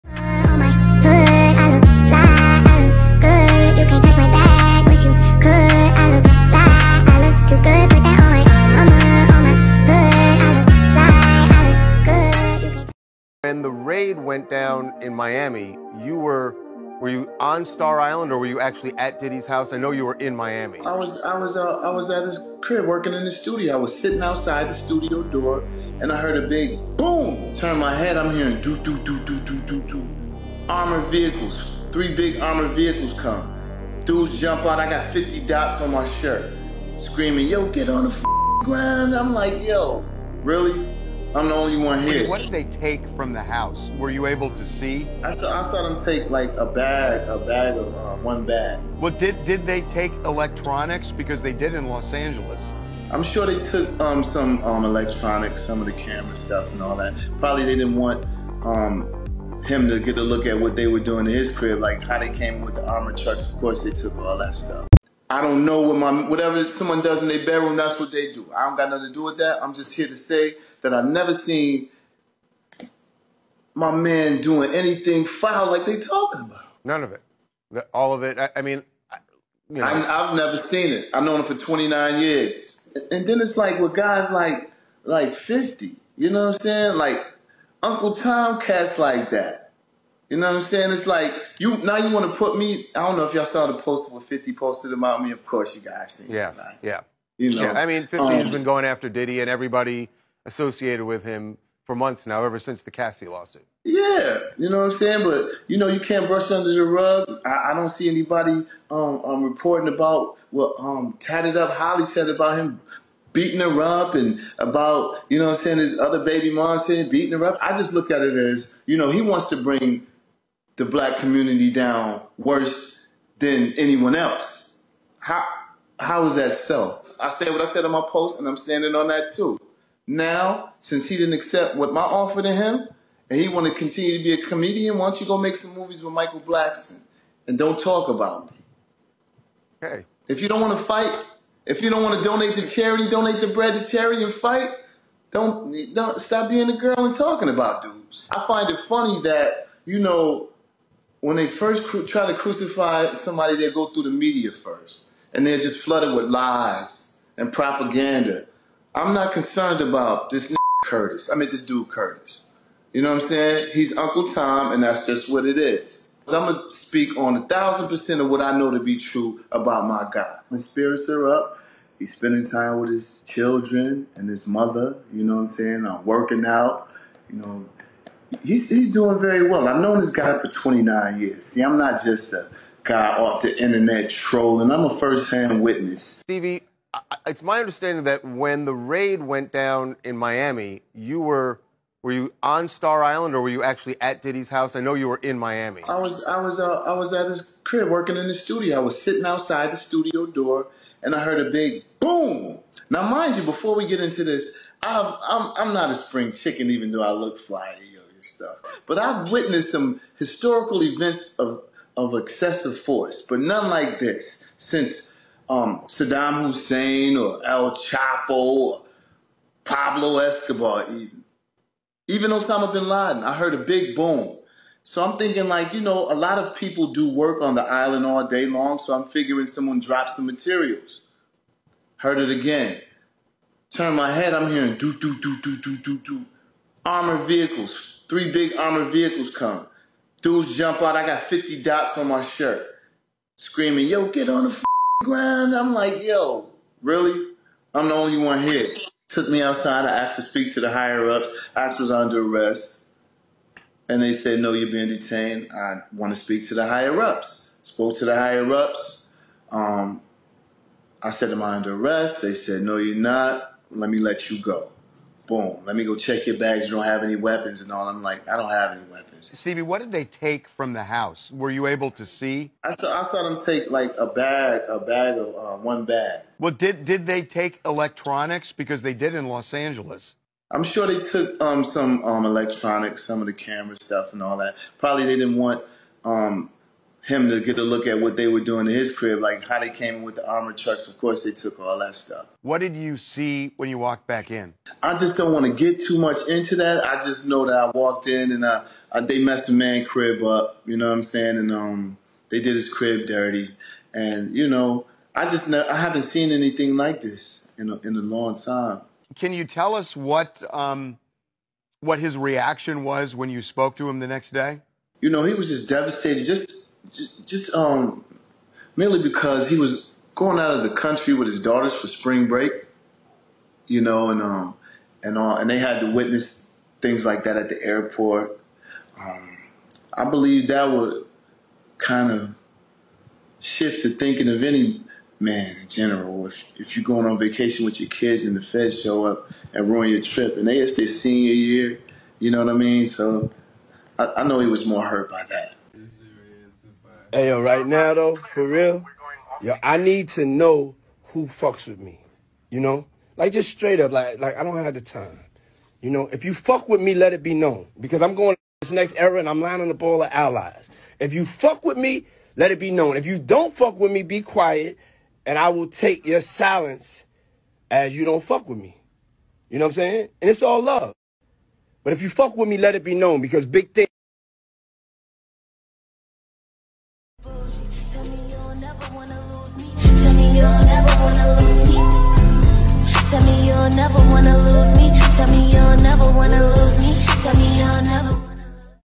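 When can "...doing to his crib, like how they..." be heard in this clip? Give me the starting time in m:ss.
4:48.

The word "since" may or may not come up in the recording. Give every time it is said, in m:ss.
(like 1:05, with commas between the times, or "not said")
1:42, 2:10, 3:34.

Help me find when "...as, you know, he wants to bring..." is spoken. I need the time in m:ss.
1:58.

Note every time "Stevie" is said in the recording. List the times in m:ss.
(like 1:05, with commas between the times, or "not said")
3:06, 4:29.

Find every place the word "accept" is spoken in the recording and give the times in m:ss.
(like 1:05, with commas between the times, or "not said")
2:11.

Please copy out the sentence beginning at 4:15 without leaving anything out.
I want to speak to the higher ups.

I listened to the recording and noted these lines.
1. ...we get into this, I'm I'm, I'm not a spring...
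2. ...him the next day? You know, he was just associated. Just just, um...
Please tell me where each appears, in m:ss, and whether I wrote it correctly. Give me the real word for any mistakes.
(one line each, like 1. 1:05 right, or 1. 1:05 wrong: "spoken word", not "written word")
1. 3:23 right
2. 5:13 wrong: "devastated", not "associated".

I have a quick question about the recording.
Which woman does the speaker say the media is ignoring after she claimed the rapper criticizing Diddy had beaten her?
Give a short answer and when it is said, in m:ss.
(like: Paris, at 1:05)
Tatted Up Holly, at 1:51.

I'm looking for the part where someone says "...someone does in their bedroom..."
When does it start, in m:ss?
1:06.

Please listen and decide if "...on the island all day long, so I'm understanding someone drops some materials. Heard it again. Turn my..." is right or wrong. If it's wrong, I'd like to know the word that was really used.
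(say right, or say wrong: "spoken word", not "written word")
wrong: "figuring", not "understanding".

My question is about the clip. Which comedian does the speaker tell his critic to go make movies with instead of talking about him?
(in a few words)
Michael Blackson.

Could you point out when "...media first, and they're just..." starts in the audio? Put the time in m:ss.
2:34.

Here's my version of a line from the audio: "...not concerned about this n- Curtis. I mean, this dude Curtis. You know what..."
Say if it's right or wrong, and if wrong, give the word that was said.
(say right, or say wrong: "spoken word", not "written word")
right.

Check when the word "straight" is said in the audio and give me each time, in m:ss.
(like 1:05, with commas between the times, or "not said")
5:53.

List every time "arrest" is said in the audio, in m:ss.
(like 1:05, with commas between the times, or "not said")
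4:12, 4:21.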